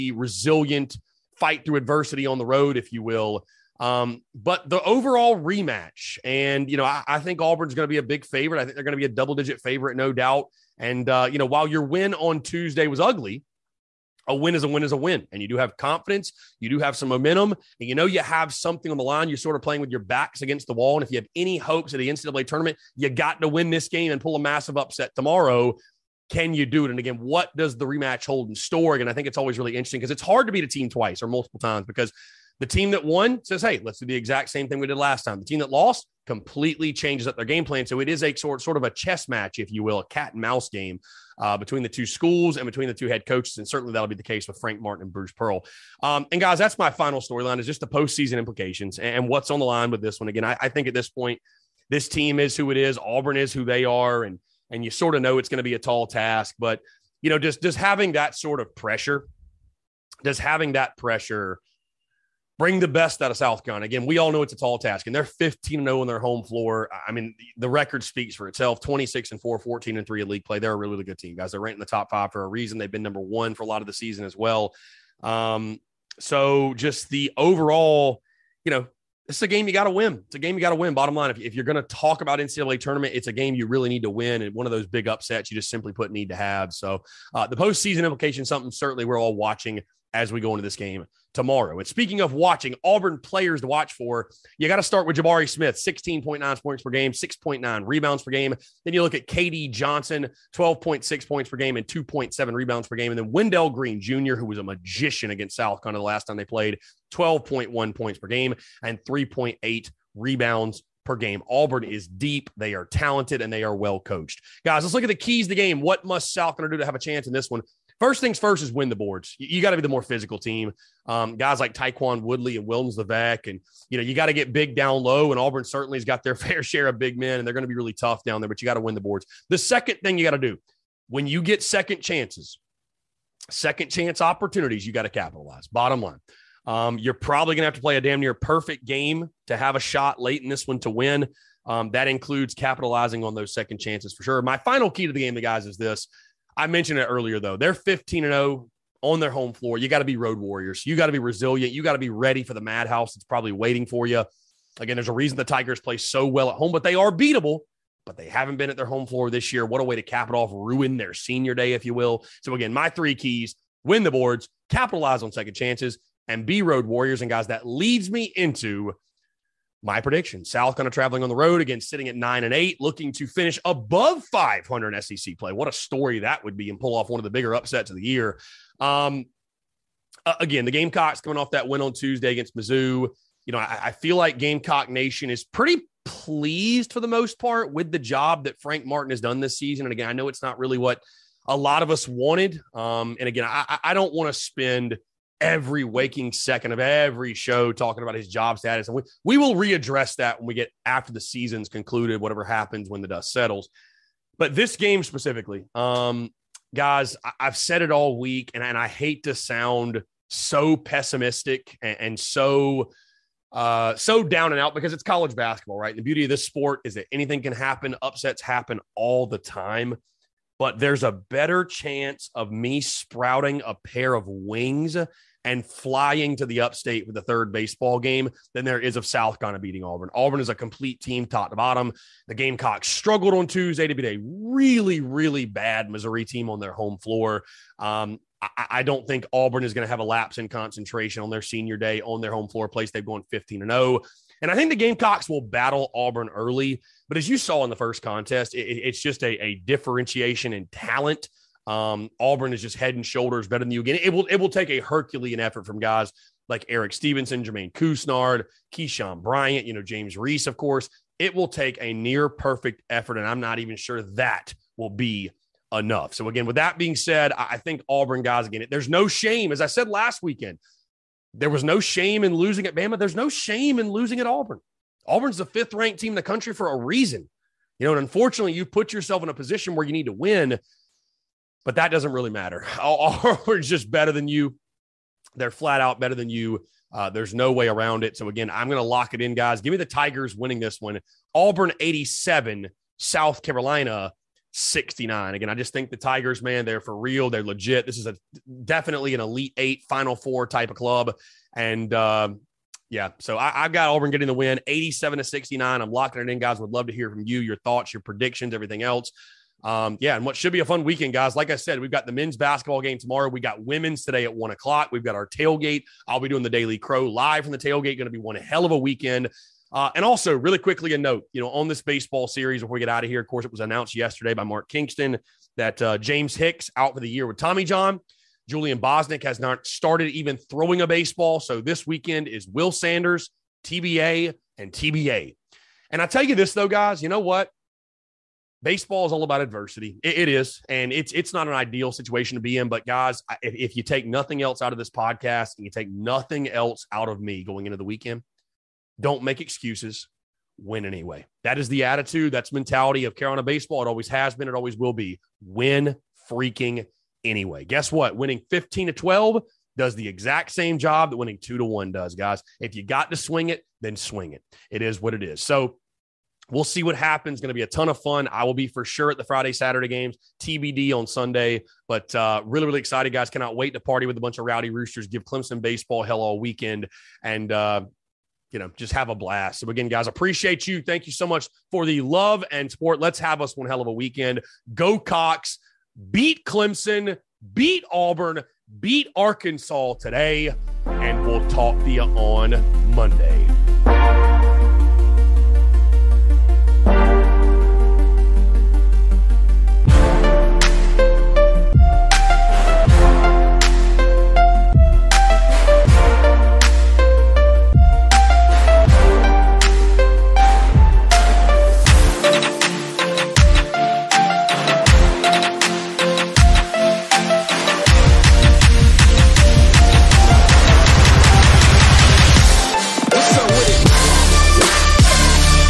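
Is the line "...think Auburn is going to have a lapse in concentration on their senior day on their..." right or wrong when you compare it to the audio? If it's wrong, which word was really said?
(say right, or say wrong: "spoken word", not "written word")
right.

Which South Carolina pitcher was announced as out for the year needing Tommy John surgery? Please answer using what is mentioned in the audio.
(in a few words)
James Hicks.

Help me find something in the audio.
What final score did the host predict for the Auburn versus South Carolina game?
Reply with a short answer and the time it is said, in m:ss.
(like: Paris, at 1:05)
87-69, at 4:51.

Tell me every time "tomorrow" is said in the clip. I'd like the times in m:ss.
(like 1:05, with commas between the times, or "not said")
0:25, 1:31, 5:12.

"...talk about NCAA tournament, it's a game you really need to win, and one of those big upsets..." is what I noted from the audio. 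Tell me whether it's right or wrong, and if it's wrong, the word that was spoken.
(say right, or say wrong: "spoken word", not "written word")
right.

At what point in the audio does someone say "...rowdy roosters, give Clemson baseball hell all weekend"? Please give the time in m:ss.
6:14.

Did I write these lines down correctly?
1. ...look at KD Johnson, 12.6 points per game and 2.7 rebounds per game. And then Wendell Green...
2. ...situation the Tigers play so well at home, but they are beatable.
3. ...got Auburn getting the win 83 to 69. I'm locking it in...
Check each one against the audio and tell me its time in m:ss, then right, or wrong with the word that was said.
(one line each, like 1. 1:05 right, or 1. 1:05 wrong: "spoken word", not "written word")
1. 1:39 right
2. 2:35 wrong: "reason", not "situation"
3. 5:03 wrong: "87", not "83".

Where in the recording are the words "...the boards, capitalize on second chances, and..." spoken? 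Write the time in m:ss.
2:44.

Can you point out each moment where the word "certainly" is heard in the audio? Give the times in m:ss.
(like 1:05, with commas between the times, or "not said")
0:43, 1:28, 2:05.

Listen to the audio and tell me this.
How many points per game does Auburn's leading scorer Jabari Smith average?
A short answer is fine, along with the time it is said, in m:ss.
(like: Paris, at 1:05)
16.9, at 1:35.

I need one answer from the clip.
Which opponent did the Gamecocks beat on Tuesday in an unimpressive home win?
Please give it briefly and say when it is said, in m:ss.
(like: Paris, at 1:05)
Missouri, at 3:02.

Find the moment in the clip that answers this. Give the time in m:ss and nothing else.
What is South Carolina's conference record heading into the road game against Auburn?
2:52.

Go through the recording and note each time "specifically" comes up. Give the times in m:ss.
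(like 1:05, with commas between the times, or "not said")
3:25.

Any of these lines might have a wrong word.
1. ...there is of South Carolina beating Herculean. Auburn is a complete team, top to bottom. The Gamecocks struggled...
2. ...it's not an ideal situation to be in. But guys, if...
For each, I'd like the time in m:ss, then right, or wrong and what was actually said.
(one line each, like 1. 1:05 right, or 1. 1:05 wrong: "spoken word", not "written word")
1. 3:48 wrong: "Auburn", not "Herculean"
2. 5:41 right.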